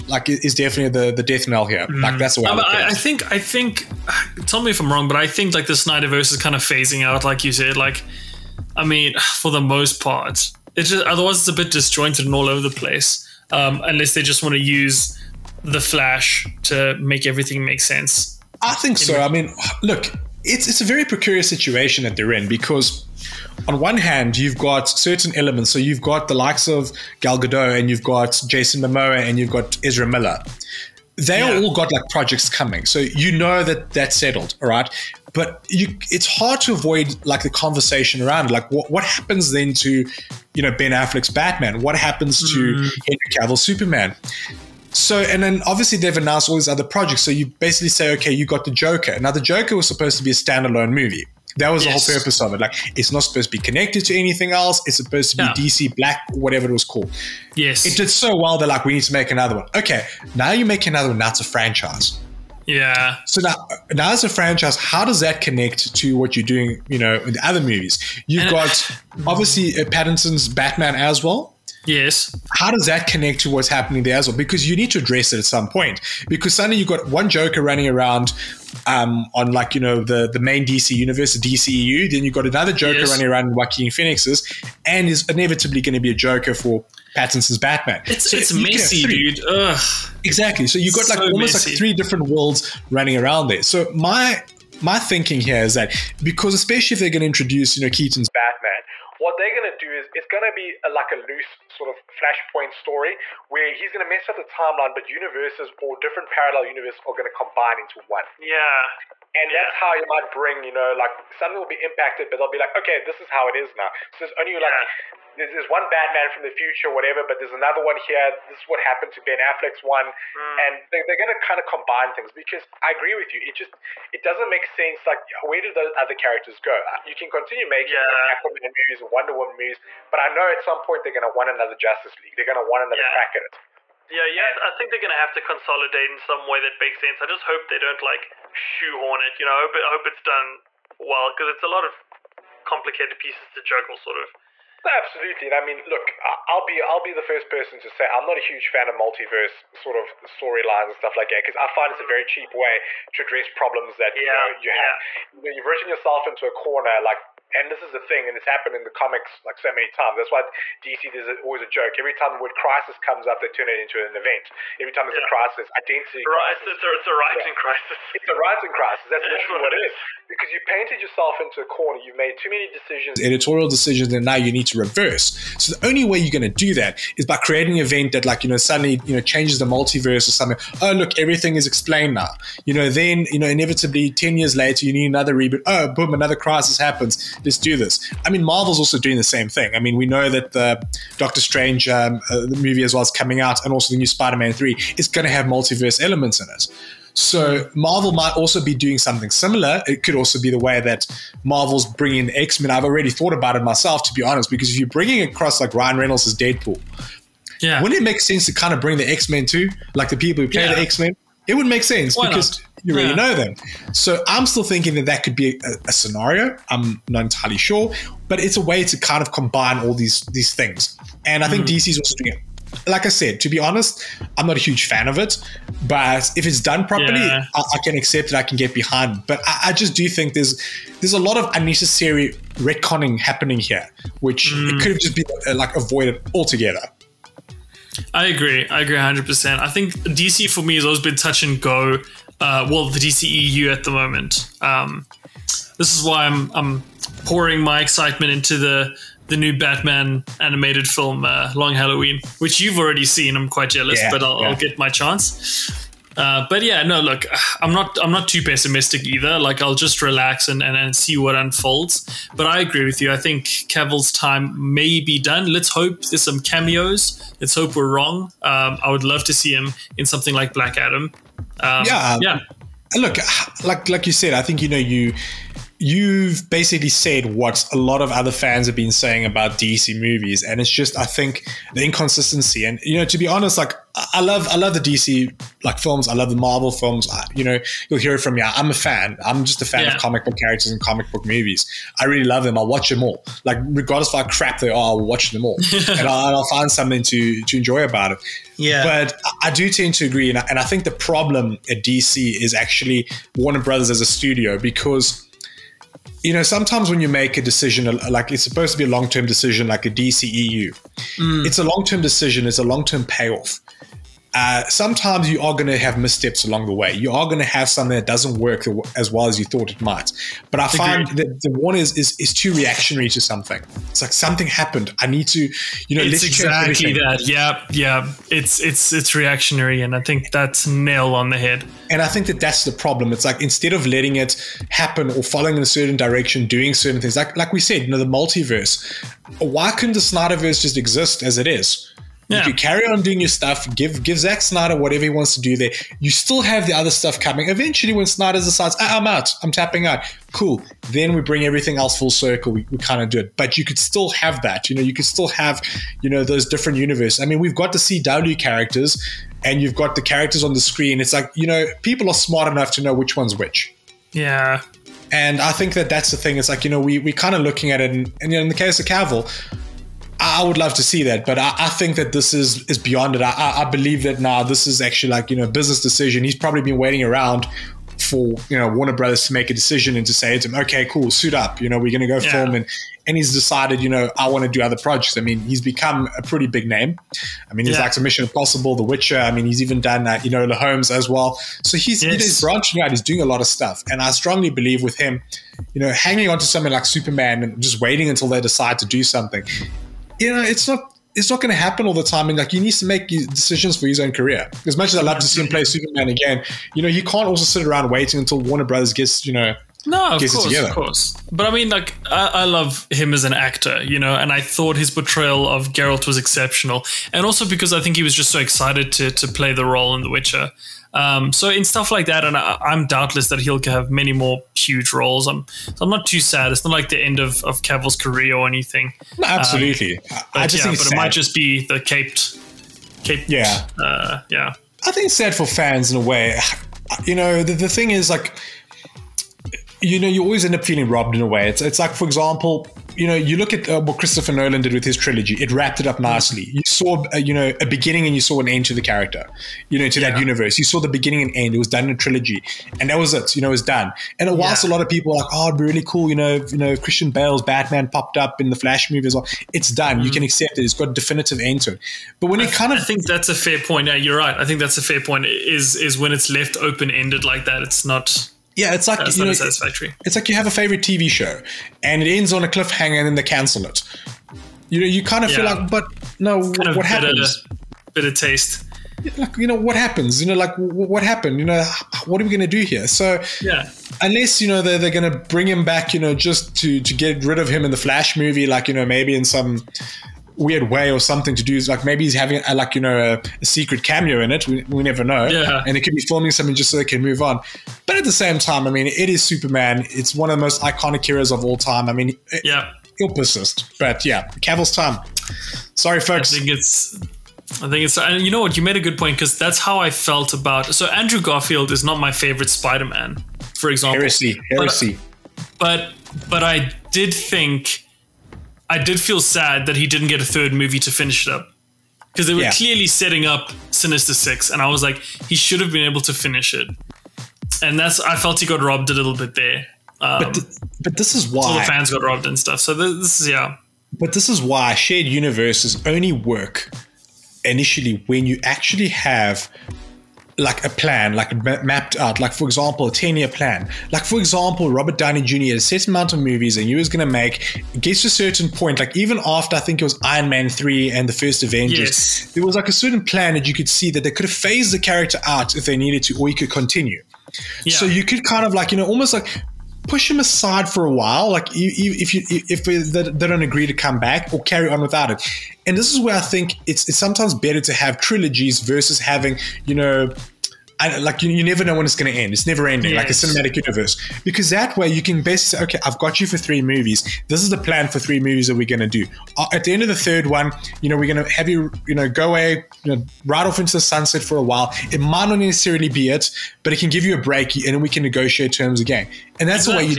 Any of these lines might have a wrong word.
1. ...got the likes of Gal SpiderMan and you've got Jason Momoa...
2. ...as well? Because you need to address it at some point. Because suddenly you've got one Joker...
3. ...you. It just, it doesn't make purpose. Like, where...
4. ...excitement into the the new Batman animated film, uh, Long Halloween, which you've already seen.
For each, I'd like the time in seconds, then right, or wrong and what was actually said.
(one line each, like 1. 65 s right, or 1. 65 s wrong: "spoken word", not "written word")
1. 26 s wrong: "Gadot", not "SpiderMan"
2. 74 s right
3. 123 s wrong: "sense", not "purpose"
4. 247 s right.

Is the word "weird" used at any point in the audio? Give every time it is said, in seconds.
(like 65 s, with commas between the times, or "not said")
490 s.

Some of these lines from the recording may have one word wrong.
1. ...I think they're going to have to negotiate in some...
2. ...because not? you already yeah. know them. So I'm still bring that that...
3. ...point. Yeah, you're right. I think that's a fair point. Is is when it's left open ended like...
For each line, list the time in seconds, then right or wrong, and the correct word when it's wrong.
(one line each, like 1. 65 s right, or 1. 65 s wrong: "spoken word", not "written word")
1. 134 s wrong: "consolidate", not "negotiate"
2. 212 s wrong: "thinking", not "bring"
3. 463 s right.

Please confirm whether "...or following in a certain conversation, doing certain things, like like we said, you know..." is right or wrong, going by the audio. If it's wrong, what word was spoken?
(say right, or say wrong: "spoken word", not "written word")
wrong: "direction", not "conversation".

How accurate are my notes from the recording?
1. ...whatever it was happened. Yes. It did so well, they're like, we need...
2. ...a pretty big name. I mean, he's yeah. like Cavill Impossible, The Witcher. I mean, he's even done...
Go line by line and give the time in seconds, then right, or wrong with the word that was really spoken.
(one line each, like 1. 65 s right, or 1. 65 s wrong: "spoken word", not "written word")
1. 56 s wrong: "called", not "happened"
2. 386 s wrong: "Mission", not "Cavill".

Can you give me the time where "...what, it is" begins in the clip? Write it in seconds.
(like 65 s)
169 s.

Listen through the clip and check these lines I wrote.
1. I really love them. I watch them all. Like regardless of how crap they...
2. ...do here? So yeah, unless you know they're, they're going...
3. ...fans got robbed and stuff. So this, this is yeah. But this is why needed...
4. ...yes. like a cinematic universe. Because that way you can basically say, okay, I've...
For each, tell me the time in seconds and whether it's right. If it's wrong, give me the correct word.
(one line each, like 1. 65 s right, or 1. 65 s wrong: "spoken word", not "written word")
1. 291 s right
2. 482 s right
3. 531 s wrong: "shared", not "needed"
4. 572 s right.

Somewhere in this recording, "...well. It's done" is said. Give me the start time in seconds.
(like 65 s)
459 s.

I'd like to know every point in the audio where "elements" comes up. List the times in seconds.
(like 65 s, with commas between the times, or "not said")
25 s, 196 s.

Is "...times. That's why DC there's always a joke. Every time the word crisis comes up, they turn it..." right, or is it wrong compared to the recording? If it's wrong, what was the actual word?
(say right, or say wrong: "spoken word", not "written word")
right.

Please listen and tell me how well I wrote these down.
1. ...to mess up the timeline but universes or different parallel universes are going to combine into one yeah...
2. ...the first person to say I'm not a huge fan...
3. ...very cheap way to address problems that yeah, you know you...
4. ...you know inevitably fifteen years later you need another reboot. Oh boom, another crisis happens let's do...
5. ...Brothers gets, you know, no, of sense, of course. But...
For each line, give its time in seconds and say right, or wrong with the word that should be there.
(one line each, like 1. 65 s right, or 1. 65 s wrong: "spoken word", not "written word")
1. 104 s right
2. 147 s right
3. 152 s right
4. 183 s wrong: "ten", not "fifteen"
5. 408 s wrong: "course", not "sense".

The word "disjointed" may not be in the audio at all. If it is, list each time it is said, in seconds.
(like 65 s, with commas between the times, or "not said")
11 s.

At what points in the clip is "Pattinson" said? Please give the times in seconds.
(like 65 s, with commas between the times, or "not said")
69 s, 87 s.